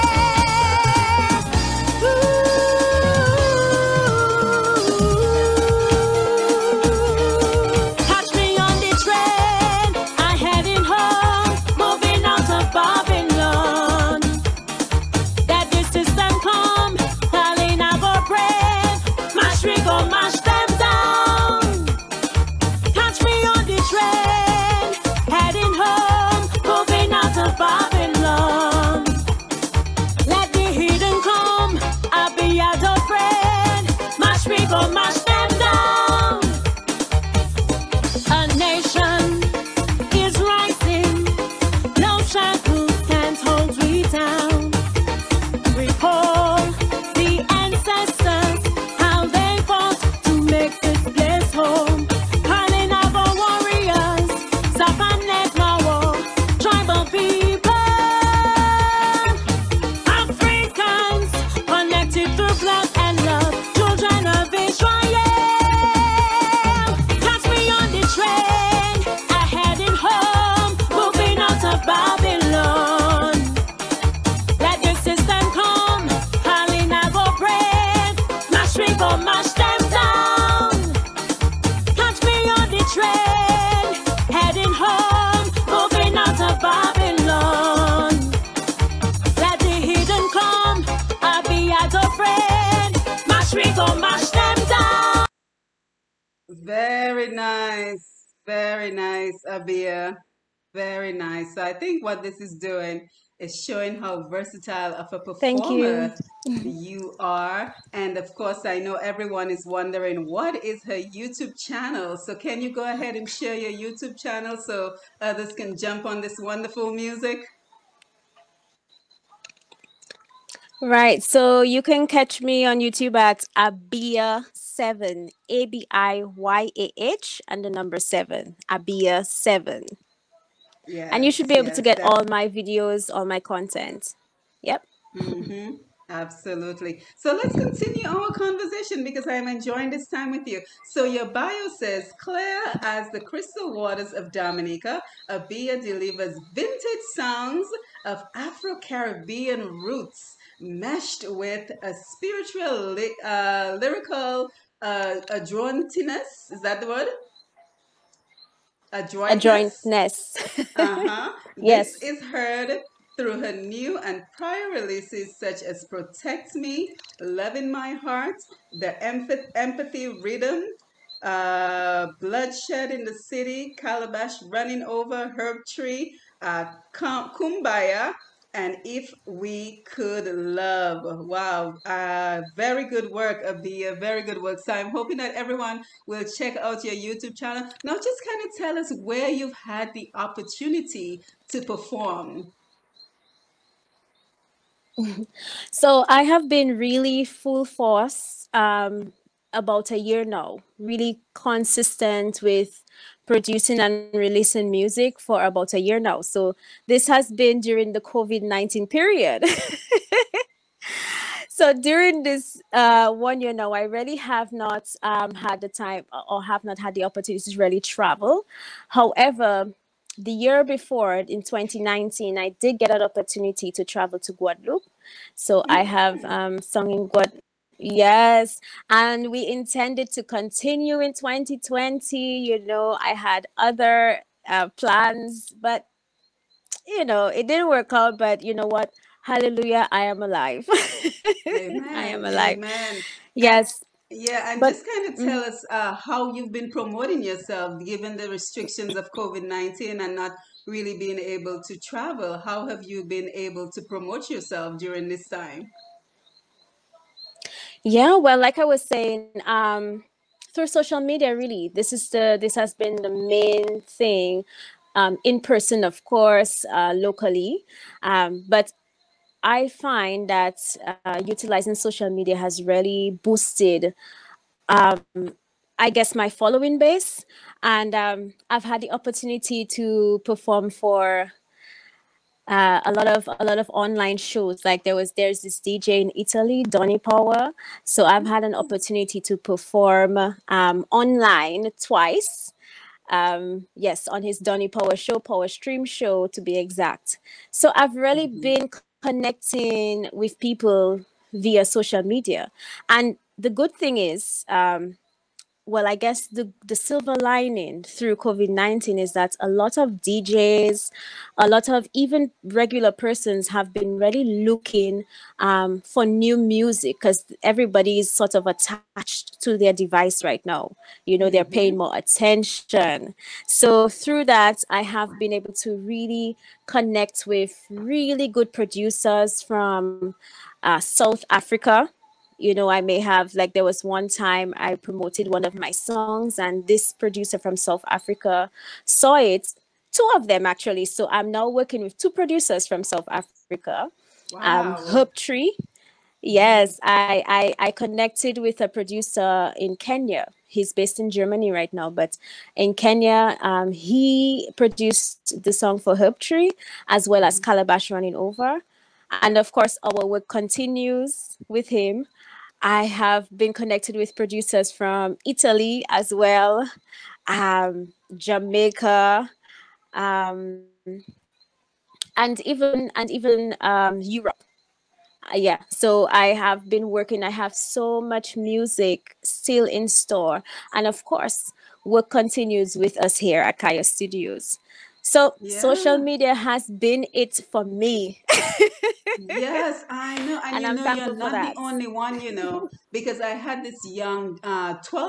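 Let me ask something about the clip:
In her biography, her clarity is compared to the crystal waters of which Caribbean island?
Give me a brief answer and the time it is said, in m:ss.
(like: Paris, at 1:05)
Dominica, at 2:24.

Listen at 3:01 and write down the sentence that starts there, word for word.
Wow, uh, very good work, AbiYah.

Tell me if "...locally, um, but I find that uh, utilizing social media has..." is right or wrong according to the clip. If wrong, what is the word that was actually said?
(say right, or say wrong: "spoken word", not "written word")
right.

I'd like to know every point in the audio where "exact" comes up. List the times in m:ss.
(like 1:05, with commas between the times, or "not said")
4:56.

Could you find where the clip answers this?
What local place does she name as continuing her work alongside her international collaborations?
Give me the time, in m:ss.
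6:23.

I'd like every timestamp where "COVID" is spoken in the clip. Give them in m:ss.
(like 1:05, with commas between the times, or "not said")
3:27, 4:09, 5:08.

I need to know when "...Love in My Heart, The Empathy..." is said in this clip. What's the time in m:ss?
2:47.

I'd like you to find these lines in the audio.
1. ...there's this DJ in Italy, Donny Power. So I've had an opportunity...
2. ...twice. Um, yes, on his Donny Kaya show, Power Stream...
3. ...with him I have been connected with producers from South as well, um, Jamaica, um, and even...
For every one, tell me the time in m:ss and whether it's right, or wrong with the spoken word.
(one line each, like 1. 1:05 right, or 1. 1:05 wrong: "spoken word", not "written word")
1. 4:45 right
2. 4:51 wrong: "Power", not "Kaya"
3. 6:01 wrong: "Italy", not "South".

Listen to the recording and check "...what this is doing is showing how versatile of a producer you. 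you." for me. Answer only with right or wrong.
wrong.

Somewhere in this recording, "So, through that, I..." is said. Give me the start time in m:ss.
5:23.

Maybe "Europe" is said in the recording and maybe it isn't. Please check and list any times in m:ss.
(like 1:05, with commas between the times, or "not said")
6:13.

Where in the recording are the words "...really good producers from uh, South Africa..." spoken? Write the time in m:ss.
5:27.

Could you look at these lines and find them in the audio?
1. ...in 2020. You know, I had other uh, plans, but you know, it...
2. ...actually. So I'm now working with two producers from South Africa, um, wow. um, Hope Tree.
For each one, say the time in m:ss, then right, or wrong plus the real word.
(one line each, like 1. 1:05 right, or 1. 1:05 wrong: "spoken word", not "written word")
1. 3:50 right
2. 5:40 right.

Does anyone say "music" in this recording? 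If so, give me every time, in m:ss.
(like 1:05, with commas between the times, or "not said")
1:56, 3:24, 5:16, 6:18.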